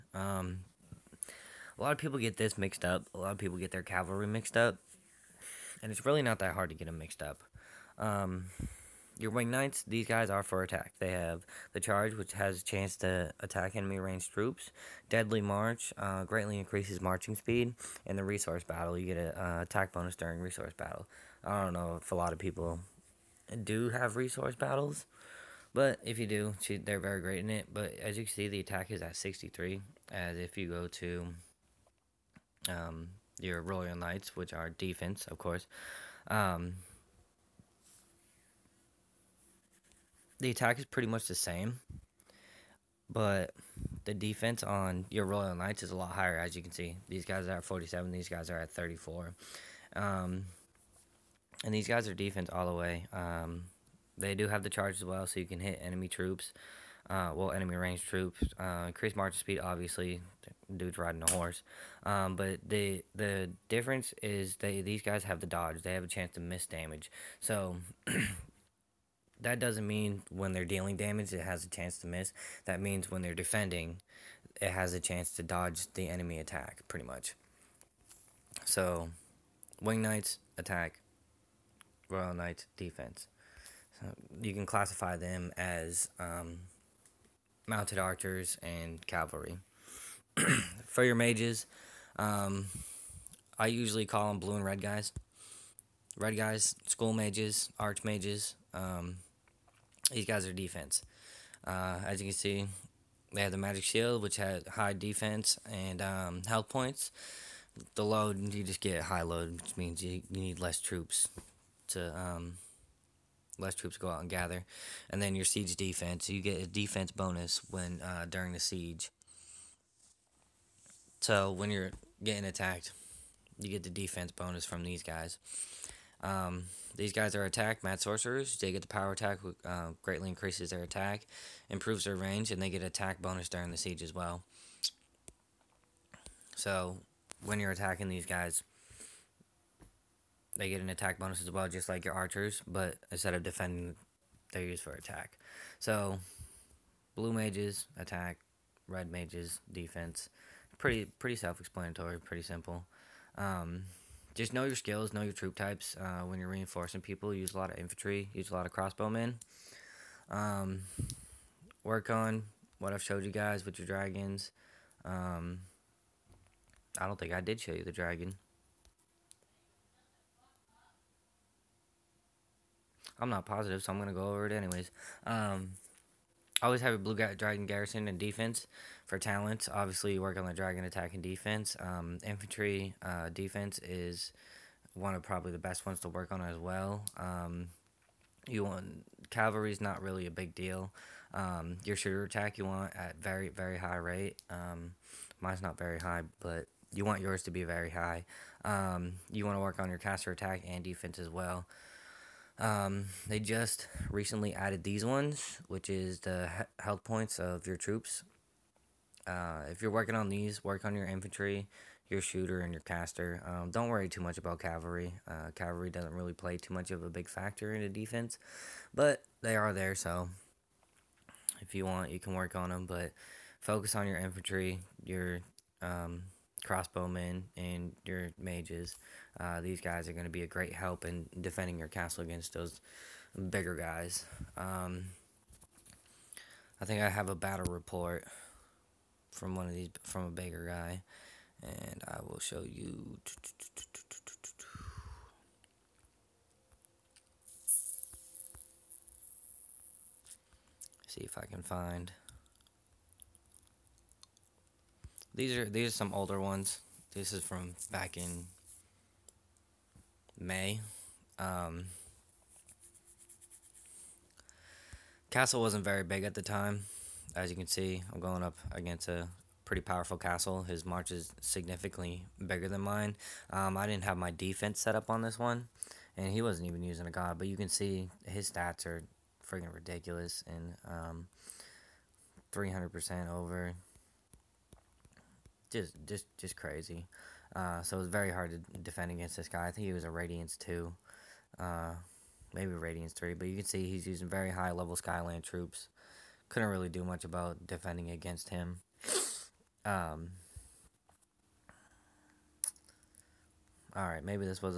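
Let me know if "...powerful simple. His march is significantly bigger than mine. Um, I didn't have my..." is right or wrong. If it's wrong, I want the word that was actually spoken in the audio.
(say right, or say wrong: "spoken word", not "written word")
wrong: "castle", not "simple".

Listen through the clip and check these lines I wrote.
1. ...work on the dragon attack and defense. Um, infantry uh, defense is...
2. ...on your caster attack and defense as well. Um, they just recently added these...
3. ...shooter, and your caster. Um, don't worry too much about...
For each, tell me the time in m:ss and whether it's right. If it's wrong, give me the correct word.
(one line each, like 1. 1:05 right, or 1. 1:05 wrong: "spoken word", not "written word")
1. 3:00 right
2. 3:19 right
3. 3:32 right.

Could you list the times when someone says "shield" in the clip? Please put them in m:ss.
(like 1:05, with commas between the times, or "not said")
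1:43.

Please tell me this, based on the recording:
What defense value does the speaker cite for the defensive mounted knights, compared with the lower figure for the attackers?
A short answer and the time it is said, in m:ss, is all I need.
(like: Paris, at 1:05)
47, at 0:47.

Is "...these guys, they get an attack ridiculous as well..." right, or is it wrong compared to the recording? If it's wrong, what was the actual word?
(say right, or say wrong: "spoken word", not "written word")
wrong: "bonus", not "ridiculous".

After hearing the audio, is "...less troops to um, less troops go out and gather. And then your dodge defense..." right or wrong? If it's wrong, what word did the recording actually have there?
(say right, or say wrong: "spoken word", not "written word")
wrong: "siege", not "dodge".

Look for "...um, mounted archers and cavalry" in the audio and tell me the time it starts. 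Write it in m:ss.
1:26.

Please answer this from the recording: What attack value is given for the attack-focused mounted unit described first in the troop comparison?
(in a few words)
63.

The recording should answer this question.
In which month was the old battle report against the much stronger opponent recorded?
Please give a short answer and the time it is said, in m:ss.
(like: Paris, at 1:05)
May, at 4:20.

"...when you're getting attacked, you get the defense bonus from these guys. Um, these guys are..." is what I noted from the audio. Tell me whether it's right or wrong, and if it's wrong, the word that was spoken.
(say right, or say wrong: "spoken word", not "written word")
right.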